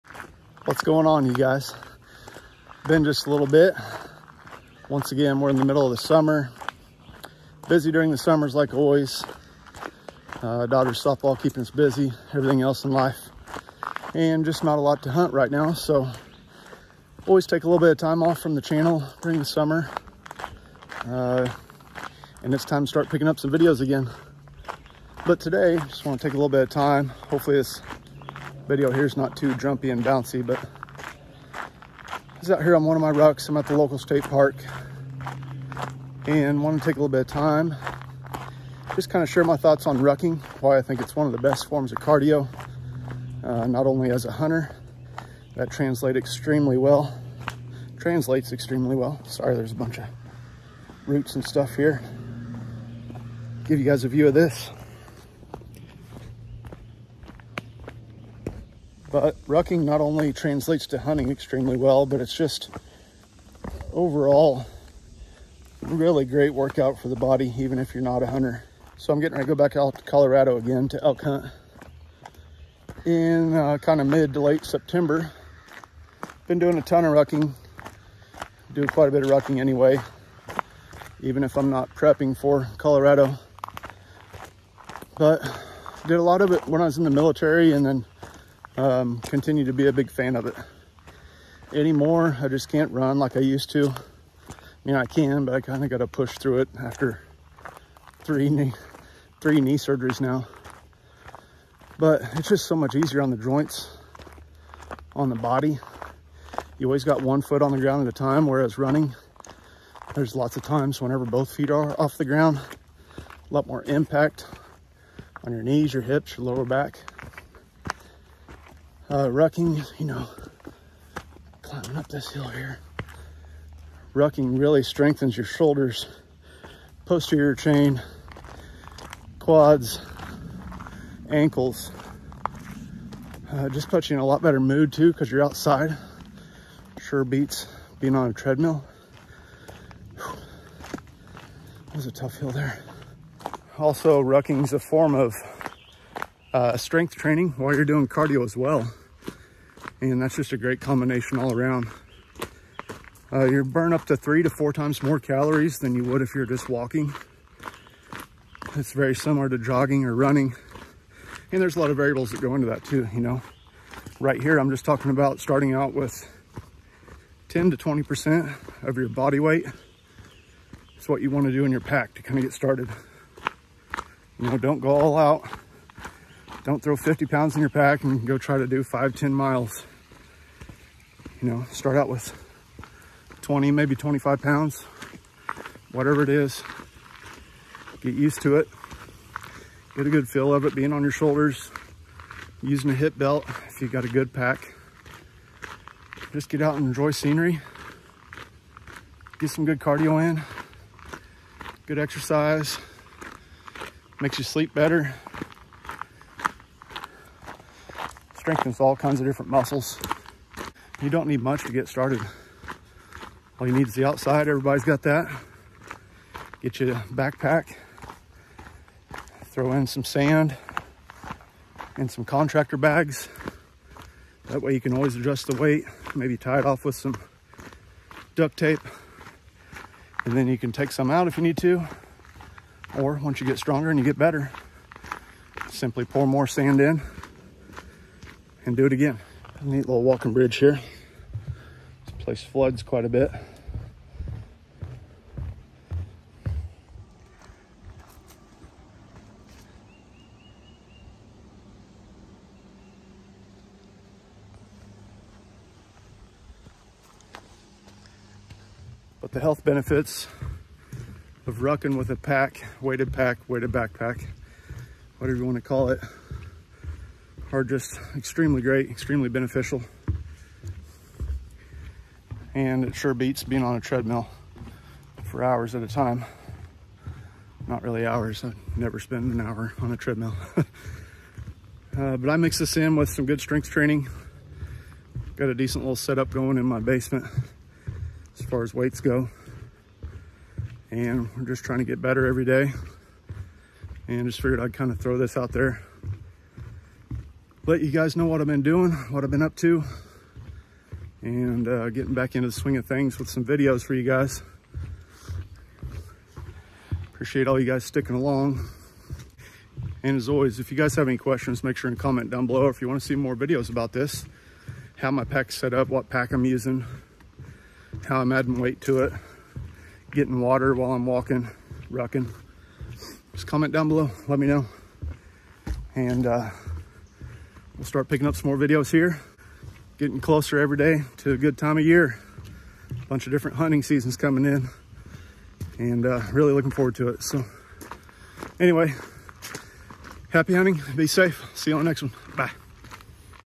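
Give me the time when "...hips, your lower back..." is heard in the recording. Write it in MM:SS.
01:56.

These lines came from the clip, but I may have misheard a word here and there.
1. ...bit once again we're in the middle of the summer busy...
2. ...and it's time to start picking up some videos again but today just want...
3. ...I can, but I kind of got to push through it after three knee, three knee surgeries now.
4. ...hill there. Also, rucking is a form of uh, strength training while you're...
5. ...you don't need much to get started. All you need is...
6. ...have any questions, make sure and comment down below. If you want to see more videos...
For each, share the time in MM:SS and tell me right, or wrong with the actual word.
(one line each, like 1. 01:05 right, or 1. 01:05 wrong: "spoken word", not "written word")
1. 00:03 right
2. 00:22 right
3. 01:34 right
4. 02:22 right
5. 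03:31 right
6. 05:10 right.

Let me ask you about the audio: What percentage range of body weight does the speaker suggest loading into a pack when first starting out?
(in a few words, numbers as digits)
10 to 20%.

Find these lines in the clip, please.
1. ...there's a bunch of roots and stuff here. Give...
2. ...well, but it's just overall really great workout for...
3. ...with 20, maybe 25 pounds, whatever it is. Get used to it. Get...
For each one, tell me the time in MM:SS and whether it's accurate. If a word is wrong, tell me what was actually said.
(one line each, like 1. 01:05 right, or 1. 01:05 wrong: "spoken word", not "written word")
1. 00:49 right
2. 01:01 right
3. 03:02 right.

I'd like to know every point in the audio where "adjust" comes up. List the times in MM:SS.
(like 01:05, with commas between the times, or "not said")
03:45.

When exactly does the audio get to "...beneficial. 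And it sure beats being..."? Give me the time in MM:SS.
04:29.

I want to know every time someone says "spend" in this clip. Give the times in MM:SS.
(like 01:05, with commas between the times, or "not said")
04:38.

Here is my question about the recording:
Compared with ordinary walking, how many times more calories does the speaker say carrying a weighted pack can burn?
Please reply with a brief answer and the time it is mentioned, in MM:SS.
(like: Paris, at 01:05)
3 to 4 times, at 02:34.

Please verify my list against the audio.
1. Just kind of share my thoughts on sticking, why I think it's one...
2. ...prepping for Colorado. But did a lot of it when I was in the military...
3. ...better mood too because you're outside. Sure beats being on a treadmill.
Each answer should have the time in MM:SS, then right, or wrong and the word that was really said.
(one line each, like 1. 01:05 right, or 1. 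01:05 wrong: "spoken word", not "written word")
1. 00:38 wrong: "rucking", not "sticking"
2. 01:21 right
3. 02:14 right.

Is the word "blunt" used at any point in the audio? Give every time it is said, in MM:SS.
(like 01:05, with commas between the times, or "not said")
not said.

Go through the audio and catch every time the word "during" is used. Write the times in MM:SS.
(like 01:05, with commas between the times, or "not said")
00:07, 00:19.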